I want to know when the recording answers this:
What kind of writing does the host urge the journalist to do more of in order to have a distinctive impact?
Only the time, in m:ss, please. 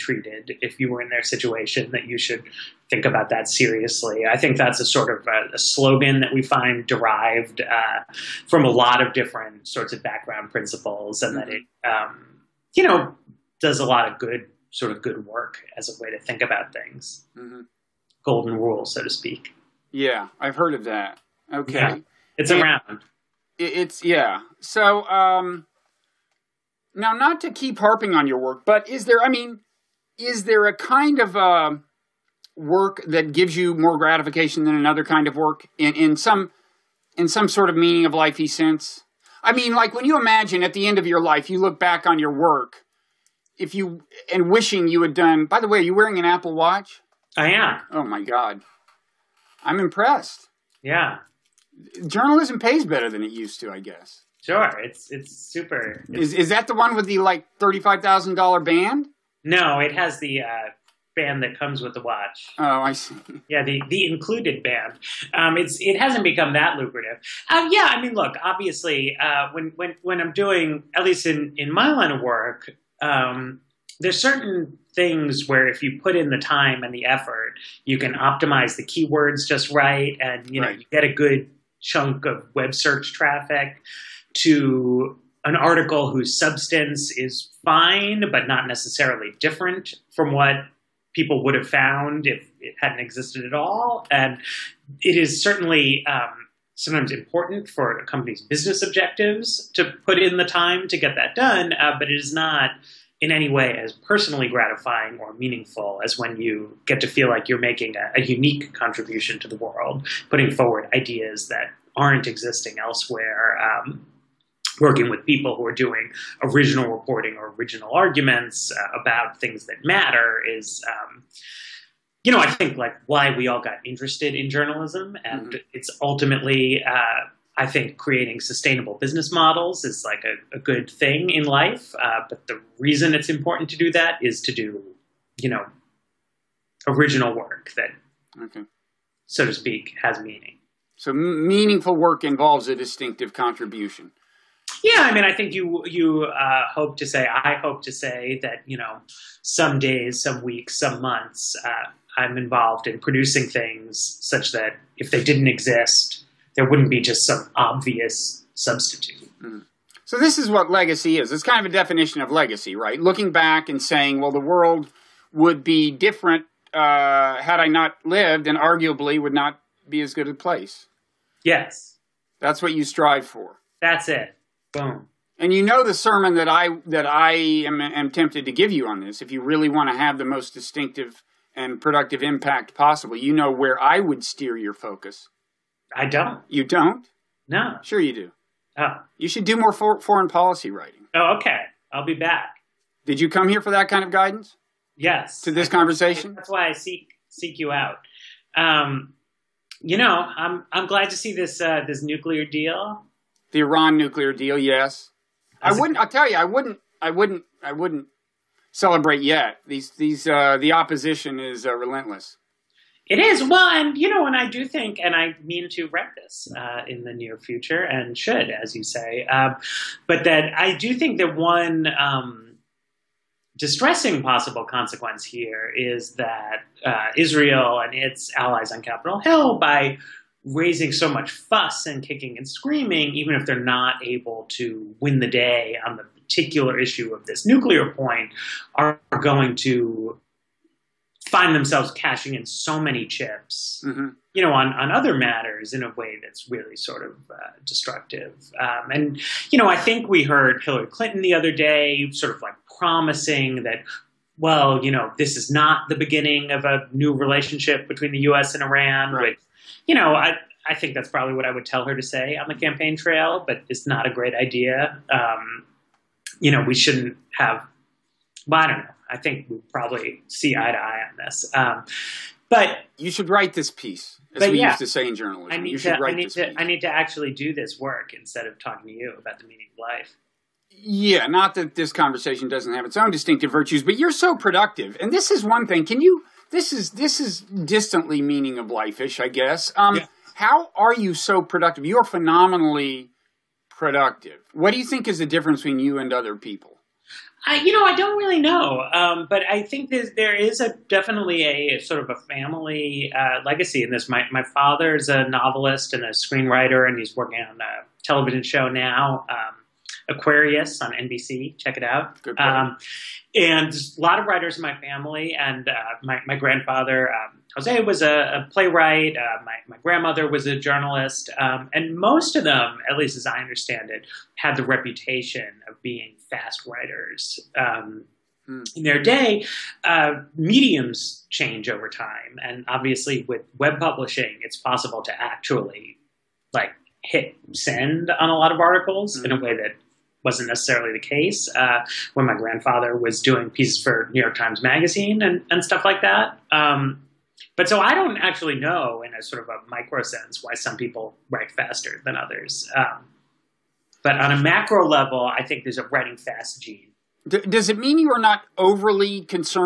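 3:10.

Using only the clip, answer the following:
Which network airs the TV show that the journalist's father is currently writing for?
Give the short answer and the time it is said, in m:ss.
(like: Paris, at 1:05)
NBC, at 5:10.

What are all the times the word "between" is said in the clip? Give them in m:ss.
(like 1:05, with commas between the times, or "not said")
4:17, 4:55.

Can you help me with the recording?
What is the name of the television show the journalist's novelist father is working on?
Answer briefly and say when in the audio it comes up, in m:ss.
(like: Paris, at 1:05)
Aquarius, at 5:10.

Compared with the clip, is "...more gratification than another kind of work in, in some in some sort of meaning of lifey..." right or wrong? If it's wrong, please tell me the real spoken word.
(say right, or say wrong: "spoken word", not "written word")
right.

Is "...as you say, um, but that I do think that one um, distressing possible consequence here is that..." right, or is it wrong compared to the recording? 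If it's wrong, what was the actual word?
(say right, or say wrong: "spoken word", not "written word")
right.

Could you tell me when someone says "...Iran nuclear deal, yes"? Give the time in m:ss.
3:23.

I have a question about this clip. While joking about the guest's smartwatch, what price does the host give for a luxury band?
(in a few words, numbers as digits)
$35,000.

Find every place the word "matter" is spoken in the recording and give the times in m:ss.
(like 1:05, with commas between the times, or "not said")
1:59, 4:05.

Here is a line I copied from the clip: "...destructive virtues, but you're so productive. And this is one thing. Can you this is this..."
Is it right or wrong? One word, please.
wrong.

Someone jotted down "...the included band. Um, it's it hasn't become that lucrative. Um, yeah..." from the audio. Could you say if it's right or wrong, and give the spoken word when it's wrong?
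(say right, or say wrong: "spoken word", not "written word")
right.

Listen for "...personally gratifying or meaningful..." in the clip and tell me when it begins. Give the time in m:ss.
1:44.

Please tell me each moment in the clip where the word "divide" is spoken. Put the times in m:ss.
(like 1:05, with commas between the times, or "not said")
not said.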